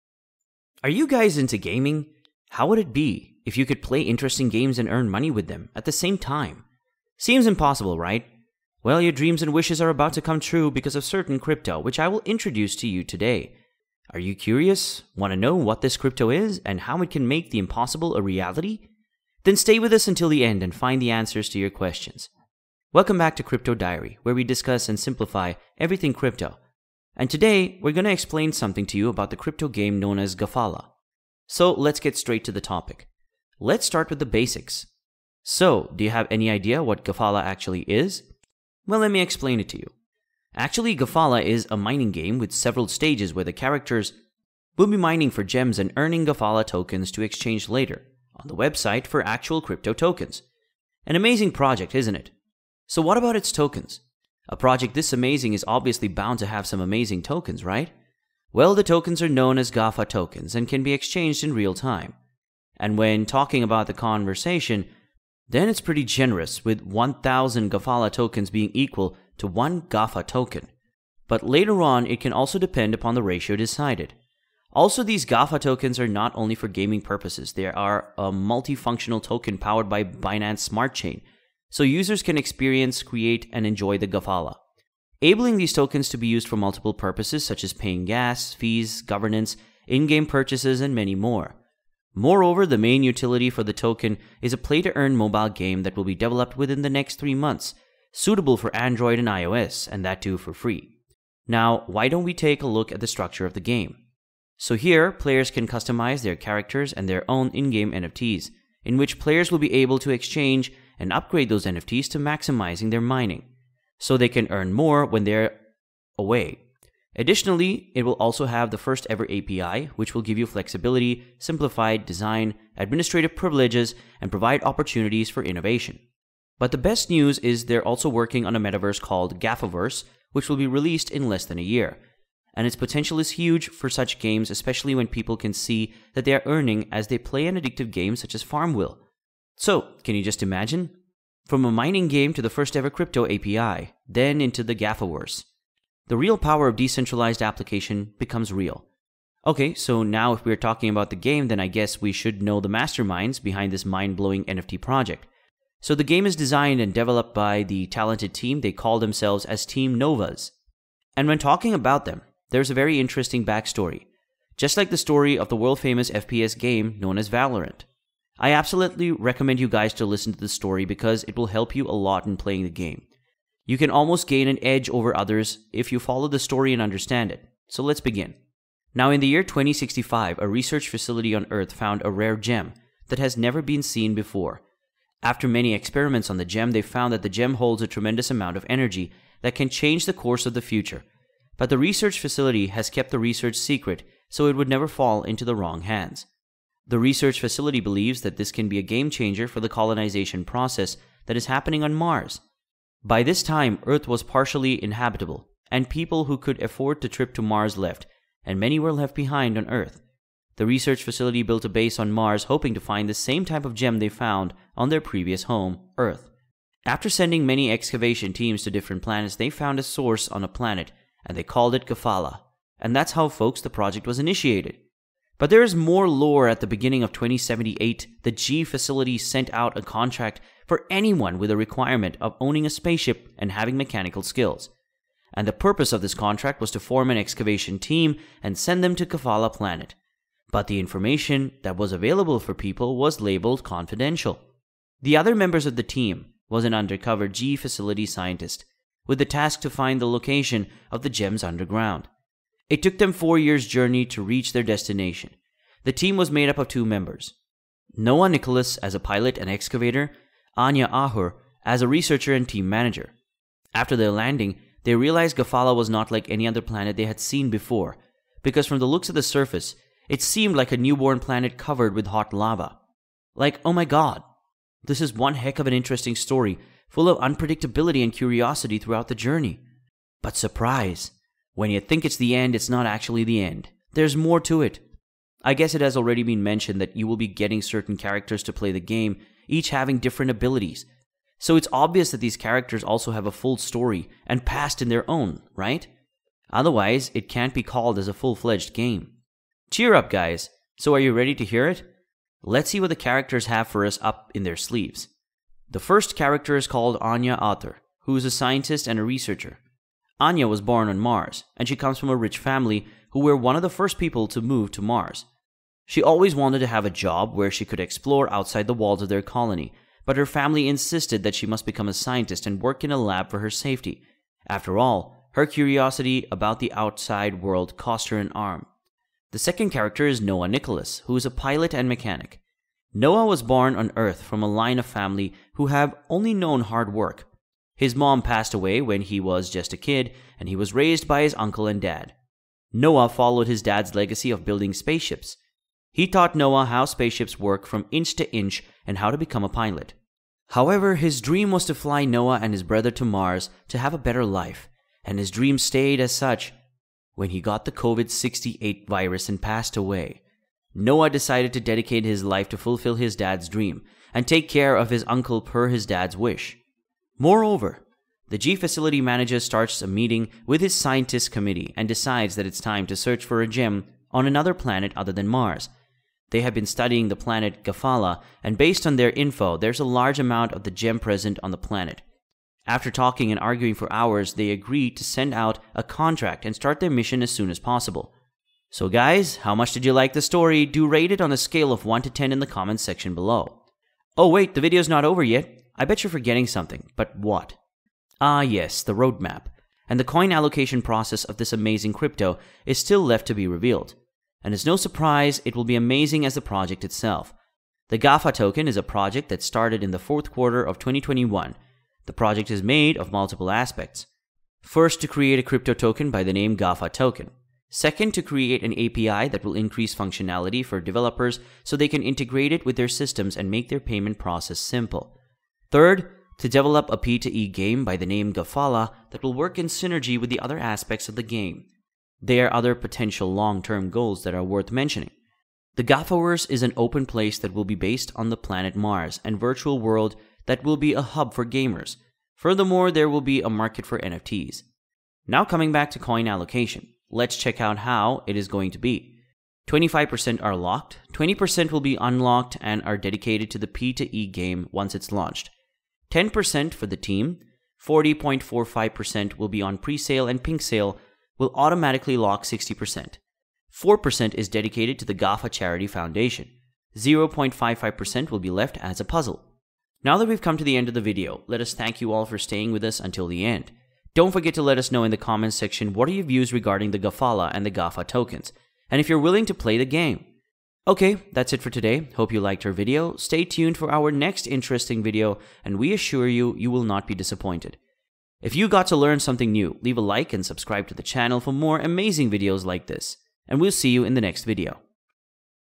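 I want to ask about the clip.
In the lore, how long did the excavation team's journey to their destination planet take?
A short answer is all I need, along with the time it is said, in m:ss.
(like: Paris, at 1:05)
4 years, at 4:13.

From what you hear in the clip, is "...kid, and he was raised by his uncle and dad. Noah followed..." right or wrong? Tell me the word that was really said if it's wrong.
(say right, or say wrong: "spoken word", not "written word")
right.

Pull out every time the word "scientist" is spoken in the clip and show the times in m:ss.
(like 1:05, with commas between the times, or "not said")
4:08, 5:08, 5:21, 6:10.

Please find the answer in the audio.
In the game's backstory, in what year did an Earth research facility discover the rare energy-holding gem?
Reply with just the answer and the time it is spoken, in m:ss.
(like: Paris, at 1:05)
2065, at 2:59.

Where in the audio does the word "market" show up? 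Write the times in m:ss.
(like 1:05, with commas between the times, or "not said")
7:23.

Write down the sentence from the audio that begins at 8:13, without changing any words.
And we'll see you in the next video.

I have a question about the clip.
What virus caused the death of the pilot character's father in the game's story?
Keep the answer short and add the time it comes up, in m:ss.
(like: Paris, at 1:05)
COVID 68, at 5:57.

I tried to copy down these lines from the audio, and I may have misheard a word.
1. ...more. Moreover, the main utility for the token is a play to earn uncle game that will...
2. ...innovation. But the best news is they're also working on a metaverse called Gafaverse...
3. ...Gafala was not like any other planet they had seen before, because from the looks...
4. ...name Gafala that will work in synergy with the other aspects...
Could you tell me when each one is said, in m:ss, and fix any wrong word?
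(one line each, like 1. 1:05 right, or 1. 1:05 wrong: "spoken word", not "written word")
1. 1:31 wrong: "mobile", not "uncle"
2. 2:05 right
3. 4:25 right
4. 7:08 right.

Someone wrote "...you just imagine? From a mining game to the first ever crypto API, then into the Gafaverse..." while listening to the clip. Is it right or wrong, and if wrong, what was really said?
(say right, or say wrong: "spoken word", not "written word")
right.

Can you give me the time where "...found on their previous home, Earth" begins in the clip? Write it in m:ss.
3:34.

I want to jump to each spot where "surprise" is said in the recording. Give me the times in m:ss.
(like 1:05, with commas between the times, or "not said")
4:40, 6:44.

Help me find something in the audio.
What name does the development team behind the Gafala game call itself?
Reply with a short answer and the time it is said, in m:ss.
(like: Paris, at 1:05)
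Team Novas, at 2:39.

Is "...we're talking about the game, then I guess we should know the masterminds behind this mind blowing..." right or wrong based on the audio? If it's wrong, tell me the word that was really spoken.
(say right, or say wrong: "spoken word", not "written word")
right.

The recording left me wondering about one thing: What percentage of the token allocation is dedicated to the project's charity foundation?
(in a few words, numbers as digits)
4%.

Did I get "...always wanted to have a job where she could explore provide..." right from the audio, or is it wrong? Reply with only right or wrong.
wrong.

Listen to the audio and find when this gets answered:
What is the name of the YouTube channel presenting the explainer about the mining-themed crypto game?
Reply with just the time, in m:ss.
0:23.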